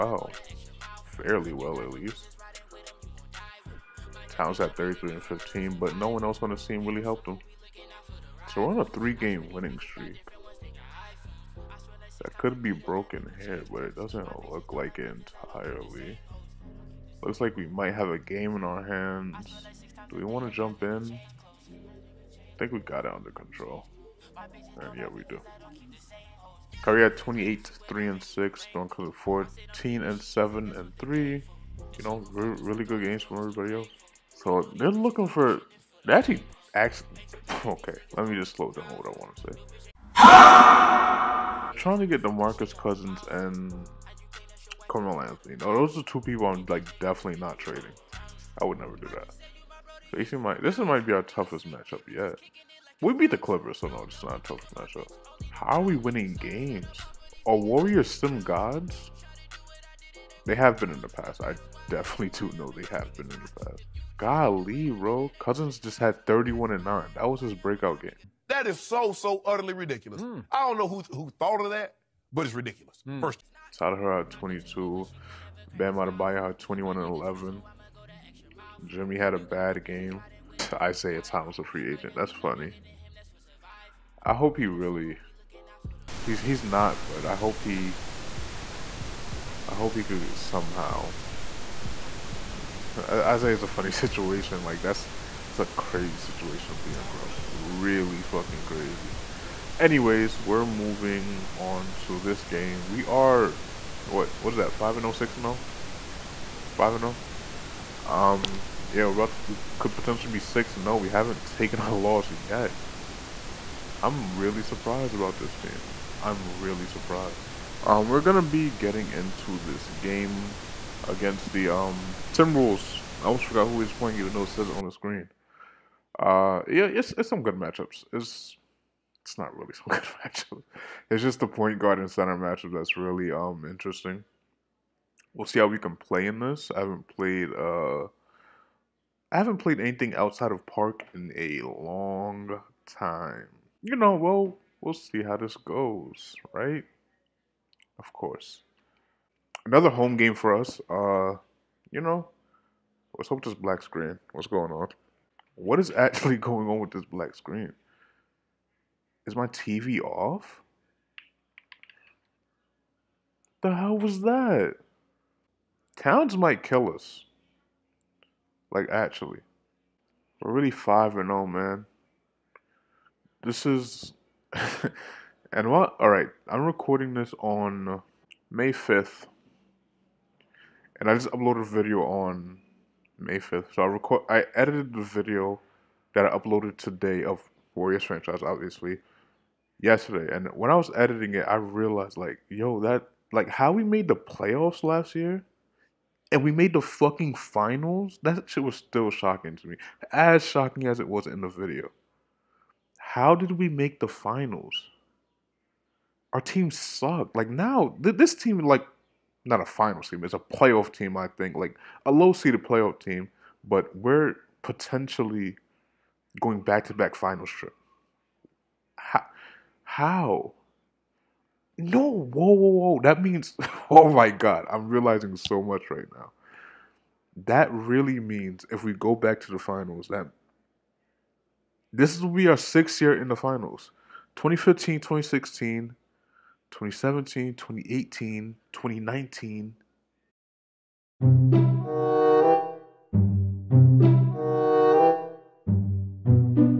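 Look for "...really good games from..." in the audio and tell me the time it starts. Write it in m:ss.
0:32.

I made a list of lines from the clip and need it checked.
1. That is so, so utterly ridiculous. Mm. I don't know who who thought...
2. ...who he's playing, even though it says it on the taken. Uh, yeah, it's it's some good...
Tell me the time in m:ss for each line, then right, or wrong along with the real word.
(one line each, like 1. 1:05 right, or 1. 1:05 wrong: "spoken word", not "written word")
1. 1:08 right
2. 2:03 wrong: "screen", not "taken".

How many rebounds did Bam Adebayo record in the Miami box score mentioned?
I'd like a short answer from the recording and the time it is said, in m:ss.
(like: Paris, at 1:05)
11, at 1:15.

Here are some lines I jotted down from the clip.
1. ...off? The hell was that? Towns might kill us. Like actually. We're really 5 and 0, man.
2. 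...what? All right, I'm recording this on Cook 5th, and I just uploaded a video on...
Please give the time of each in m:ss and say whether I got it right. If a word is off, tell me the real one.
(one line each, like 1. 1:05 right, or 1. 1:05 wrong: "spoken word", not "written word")
1. 2:40 right
2. 2:55 wrong: "May", not "Cook".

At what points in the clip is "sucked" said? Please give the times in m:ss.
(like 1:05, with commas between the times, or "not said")
3:26.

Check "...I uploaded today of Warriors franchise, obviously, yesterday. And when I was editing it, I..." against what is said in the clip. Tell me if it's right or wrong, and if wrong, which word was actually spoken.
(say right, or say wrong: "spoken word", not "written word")
right.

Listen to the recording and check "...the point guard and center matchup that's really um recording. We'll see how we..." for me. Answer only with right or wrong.
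wrong.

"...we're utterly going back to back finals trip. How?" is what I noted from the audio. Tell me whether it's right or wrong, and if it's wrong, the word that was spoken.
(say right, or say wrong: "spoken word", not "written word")
wrong: "potentially", not "utterly".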